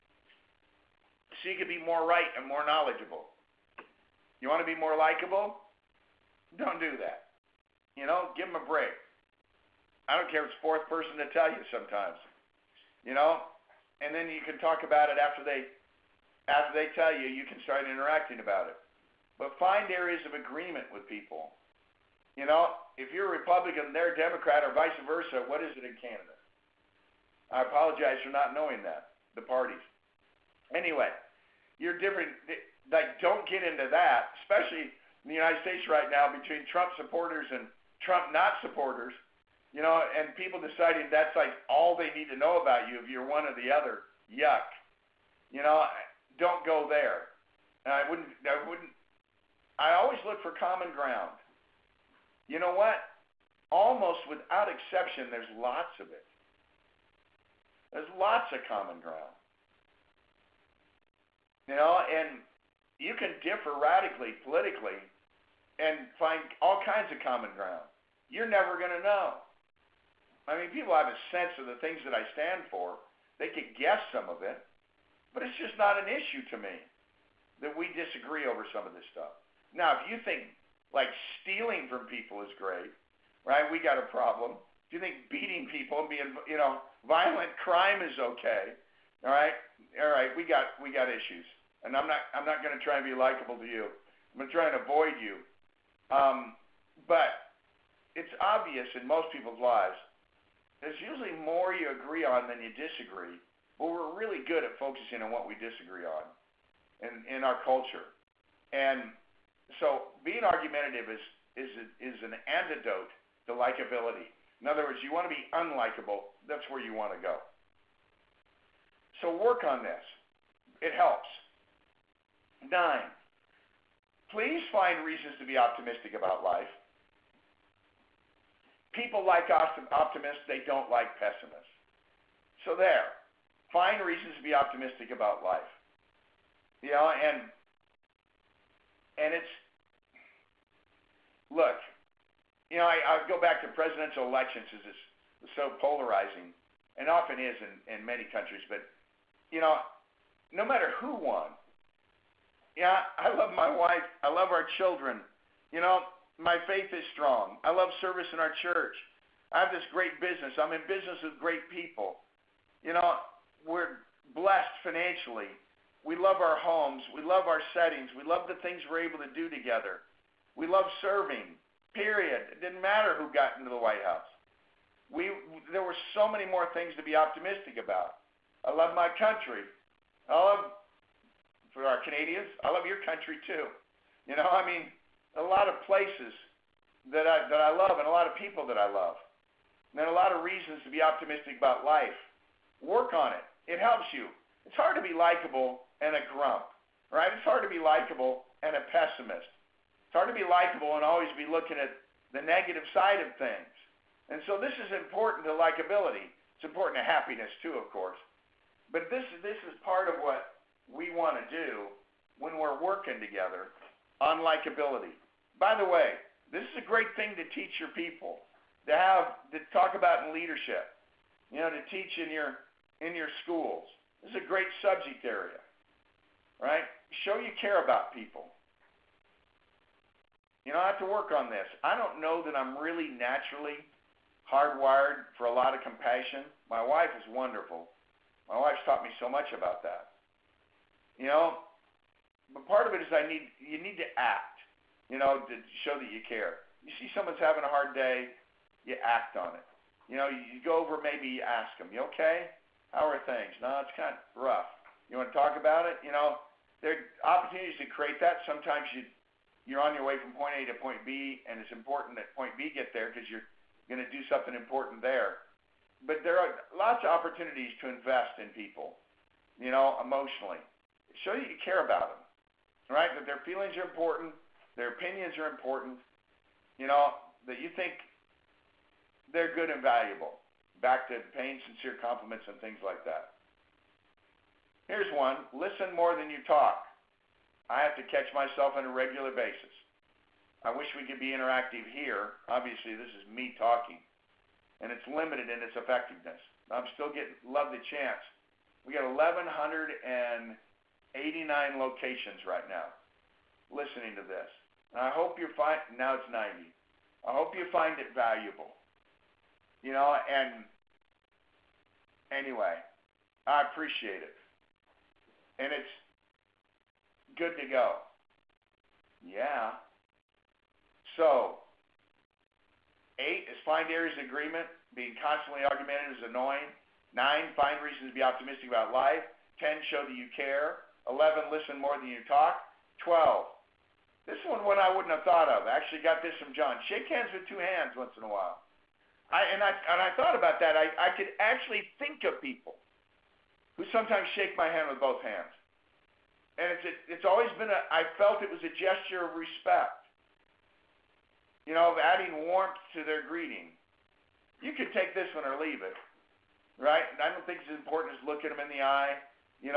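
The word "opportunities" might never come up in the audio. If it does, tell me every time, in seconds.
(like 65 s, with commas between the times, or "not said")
257 s, 267 s.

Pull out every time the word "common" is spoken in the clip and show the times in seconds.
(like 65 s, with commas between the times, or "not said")
50 s, 58 s, 67 s.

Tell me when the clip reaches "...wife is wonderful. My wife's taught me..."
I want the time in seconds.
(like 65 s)
236 s.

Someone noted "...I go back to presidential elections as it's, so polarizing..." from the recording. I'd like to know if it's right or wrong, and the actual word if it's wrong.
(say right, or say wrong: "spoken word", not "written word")
right.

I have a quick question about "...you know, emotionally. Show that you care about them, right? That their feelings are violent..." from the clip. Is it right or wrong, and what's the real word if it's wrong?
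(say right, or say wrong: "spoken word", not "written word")
wrong: "important", not "violent".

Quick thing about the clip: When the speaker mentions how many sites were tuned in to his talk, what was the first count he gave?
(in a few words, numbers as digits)
1,189.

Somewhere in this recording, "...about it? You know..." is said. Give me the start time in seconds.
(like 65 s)
255 s.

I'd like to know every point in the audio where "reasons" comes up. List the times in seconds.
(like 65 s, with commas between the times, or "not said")
125 s, 133 s, 190 s, 327 s.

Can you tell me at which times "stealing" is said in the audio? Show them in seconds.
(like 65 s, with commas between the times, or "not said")
81 s.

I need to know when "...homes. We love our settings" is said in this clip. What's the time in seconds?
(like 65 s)
166 s.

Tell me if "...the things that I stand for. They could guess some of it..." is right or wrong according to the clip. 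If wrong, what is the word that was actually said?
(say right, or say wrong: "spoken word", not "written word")
right.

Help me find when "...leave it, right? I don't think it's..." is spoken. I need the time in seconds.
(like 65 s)
355 s.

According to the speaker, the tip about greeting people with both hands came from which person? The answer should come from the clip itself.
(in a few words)
John.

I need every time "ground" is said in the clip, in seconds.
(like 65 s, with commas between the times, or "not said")
50 s, 59 s, 67 s.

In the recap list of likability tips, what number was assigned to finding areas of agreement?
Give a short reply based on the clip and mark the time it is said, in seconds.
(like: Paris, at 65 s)
8, at 323 s.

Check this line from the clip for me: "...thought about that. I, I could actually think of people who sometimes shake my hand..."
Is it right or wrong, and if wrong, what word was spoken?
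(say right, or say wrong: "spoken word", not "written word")
right.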